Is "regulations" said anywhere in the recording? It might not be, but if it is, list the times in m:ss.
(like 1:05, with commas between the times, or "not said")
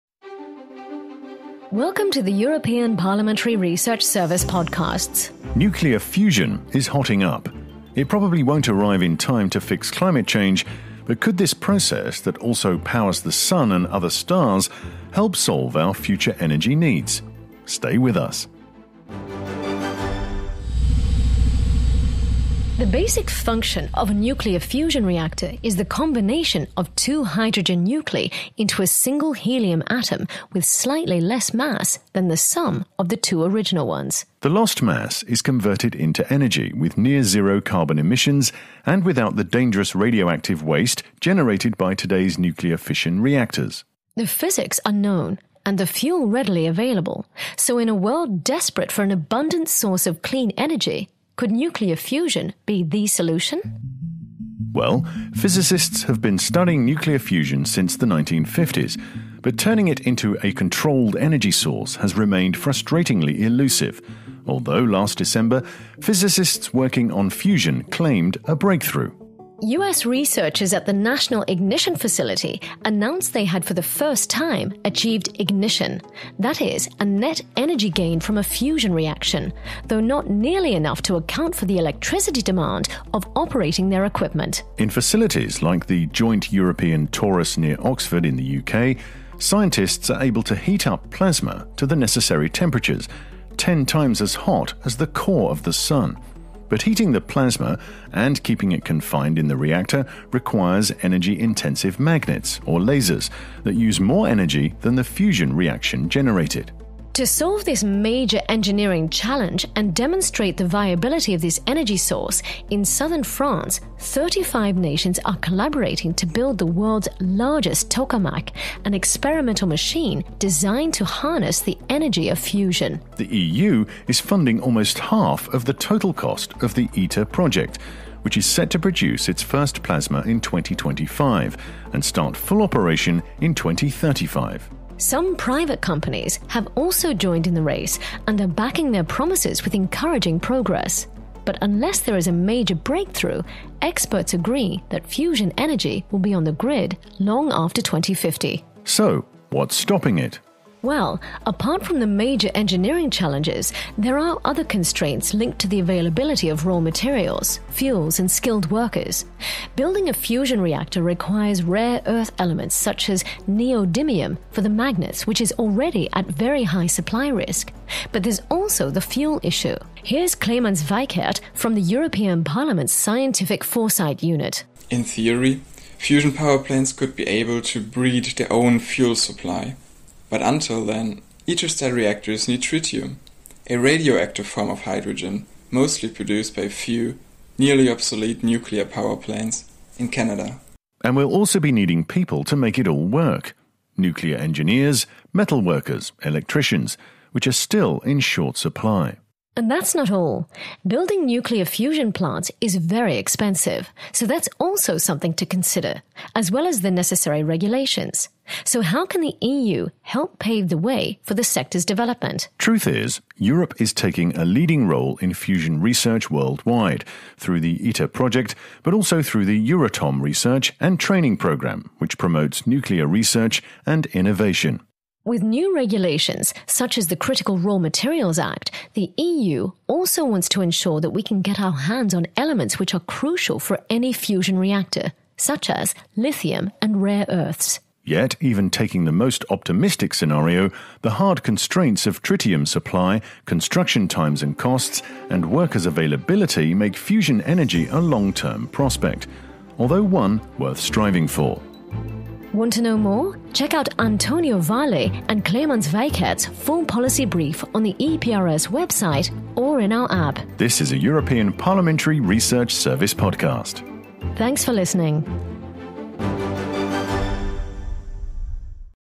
3:27, 3:45.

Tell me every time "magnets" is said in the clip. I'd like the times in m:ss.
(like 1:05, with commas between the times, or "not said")
1:41, 2:44.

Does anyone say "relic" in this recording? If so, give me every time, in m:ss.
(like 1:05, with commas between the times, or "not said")
not said.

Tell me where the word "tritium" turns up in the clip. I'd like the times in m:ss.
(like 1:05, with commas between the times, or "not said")
3:02, 4:02.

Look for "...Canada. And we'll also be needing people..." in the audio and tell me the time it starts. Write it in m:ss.
3:10.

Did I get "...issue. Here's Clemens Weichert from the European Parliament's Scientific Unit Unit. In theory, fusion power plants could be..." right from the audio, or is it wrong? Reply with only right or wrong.
wrong.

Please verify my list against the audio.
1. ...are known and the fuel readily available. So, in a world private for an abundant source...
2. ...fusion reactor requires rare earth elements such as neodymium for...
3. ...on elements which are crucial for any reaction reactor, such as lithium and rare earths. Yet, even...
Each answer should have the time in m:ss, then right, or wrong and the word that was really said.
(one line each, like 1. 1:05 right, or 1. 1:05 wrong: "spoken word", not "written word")
1. 0:44 wrong: "desperate", not "private"
2. 2:40 right
3. 3:52 wrong: "fusion", not "reaction".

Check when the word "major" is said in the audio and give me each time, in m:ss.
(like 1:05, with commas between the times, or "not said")
1:47, 2:22, 2:32.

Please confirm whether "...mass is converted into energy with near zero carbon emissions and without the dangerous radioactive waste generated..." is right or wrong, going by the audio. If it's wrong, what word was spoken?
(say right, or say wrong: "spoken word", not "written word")
right.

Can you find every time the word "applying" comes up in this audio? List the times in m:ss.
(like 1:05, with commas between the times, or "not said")
not said.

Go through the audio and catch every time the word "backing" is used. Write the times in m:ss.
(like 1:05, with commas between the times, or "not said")
2:18.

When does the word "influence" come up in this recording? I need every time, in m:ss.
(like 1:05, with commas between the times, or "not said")
not said.